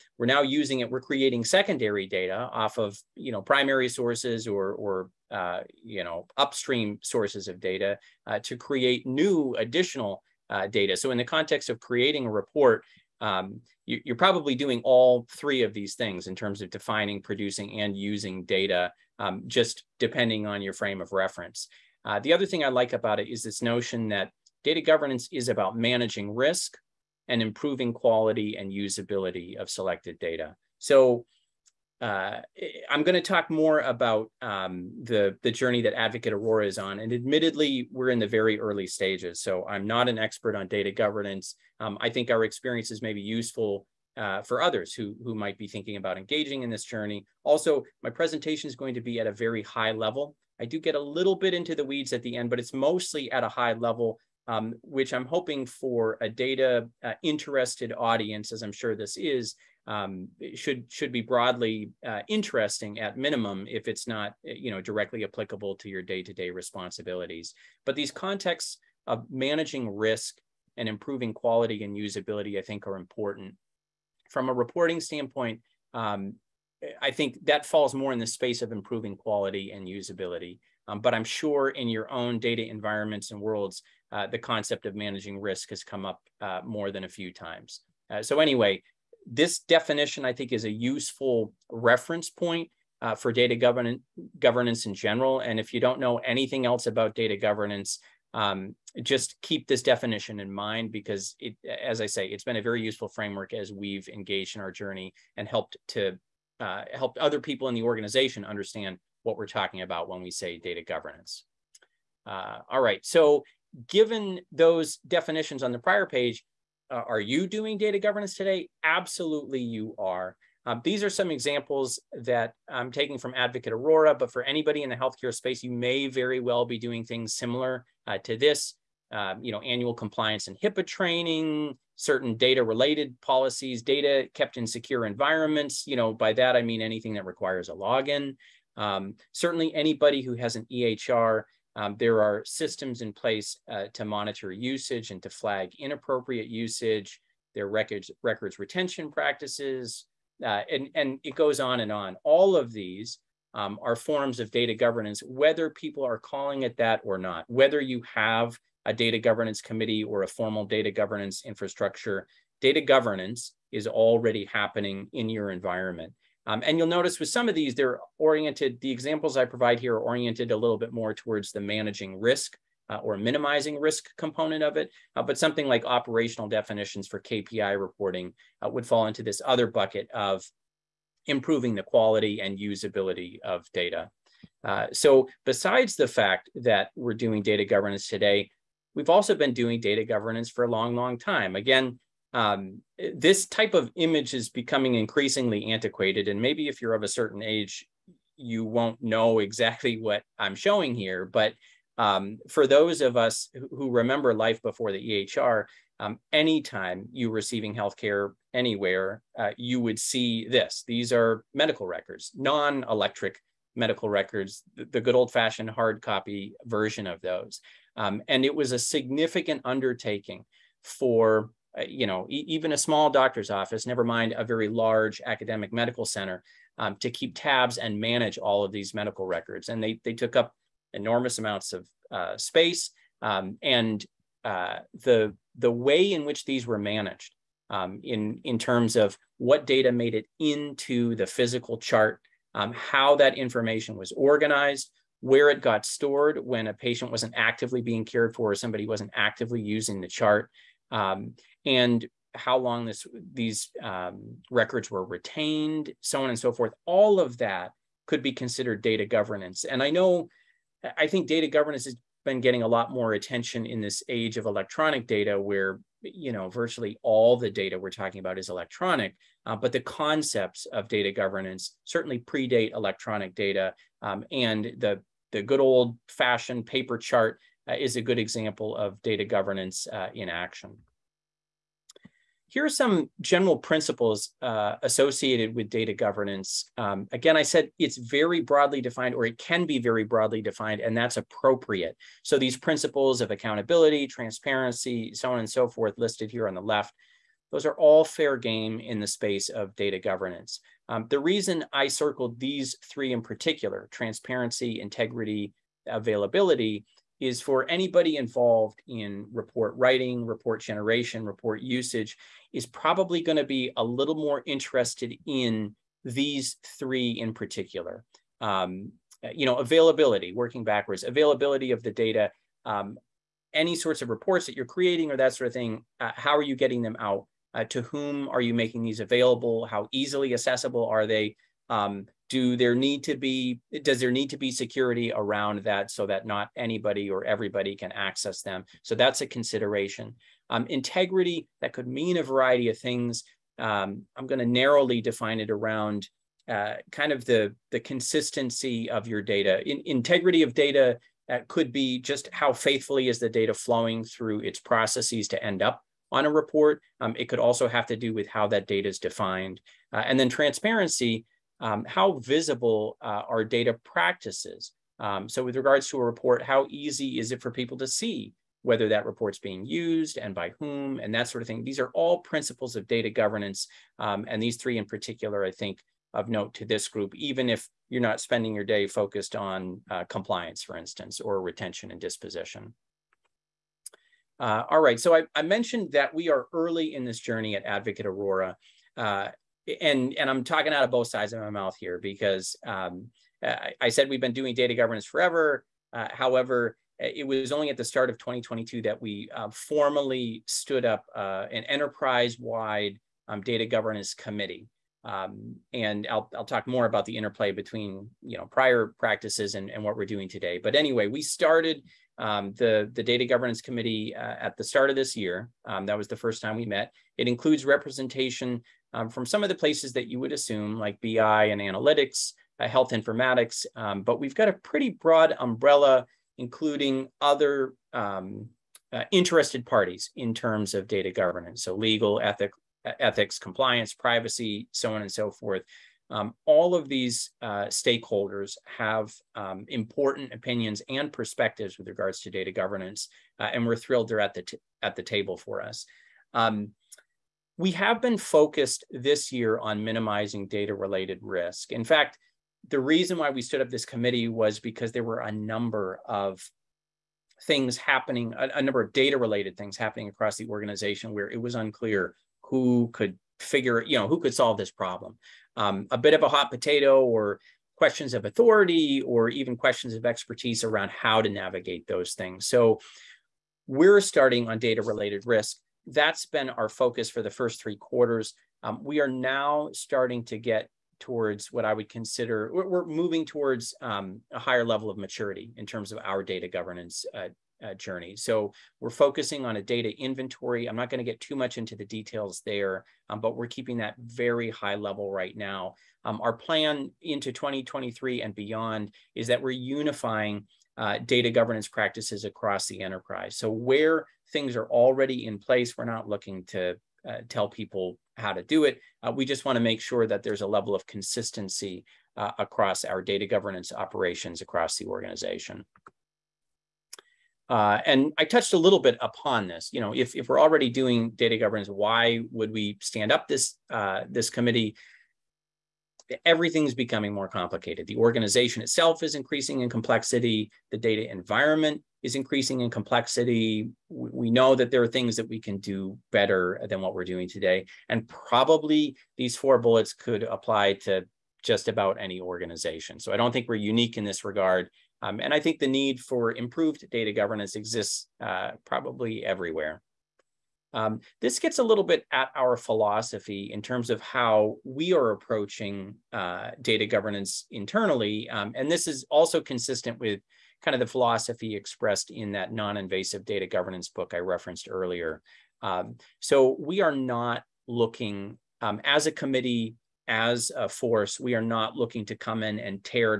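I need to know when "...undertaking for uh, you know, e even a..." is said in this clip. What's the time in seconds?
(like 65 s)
219 s.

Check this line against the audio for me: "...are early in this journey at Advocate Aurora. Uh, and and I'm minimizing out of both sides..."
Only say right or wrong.
wrong.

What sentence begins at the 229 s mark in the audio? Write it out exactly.
And they, they took up enormous amounts of uh, space.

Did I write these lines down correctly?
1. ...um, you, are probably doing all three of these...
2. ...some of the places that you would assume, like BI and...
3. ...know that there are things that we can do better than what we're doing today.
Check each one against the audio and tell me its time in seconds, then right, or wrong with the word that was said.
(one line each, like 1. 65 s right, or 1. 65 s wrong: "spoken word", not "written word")
1. 13 s right
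2. 419 s right
3. 534 s right.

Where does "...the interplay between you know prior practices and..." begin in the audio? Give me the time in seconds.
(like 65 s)
407 s.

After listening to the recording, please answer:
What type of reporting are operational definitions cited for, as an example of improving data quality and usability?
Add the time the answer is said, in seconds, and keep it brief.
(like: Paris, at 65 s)
KPI reporting, at 177 s.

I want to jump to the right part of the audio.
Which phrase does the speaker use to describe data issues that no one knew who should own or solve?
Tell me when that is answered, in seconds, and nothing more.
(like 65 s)
466 s.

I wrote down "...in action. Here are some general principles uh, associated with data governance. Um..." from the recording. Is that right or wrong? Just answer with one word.
right.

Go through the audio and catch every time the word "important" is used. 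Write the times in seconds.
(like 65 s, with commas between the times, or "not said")
72 s, 439 s.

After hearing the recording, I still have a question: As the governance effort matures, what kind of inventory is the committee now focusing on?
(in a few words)
data inventory.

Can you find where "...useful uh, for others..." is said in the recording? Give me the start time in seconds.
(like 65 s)
43 s.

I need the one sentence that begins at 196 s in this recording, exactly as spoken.
And maybe if you're of a certain age, you won't know exactly what I'm showing here.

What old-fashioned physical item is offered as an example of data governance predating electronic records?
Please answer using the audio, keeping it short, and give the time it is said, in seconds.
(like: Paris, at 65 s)
paper chart, at 276 s.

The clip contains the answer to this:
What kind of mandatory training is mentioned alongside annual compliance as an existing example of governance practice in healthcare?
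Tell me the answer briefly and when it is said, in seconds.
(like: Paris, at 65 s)
HIPAA training, at 130 s.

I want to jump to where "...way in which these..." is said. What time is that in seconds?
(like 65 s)
235 s.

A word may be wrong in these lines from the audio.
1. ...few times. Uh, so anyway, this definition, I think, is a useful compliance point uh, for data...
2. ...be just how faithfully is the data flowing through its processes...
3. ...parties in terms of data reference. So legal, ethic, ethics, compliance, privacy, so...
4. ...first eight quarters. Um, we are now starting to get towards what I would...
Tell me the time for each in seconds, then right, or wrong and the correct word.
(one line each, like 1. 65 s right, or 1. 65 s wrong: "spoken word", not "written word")
1. 87 s wrong: "reference", not "compliance"
2. 351 s right
3. 429 s wrong: "governance", not "reference"
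4. 477 s wrong: "three", not "eight".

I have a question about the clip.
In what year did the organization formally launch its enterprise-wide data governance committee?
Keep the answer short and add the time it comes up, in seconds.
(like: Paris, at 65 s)
2022, at 398 s.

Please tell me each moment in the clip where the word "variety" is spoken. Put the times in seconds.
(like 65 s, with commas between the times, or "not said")
342 s.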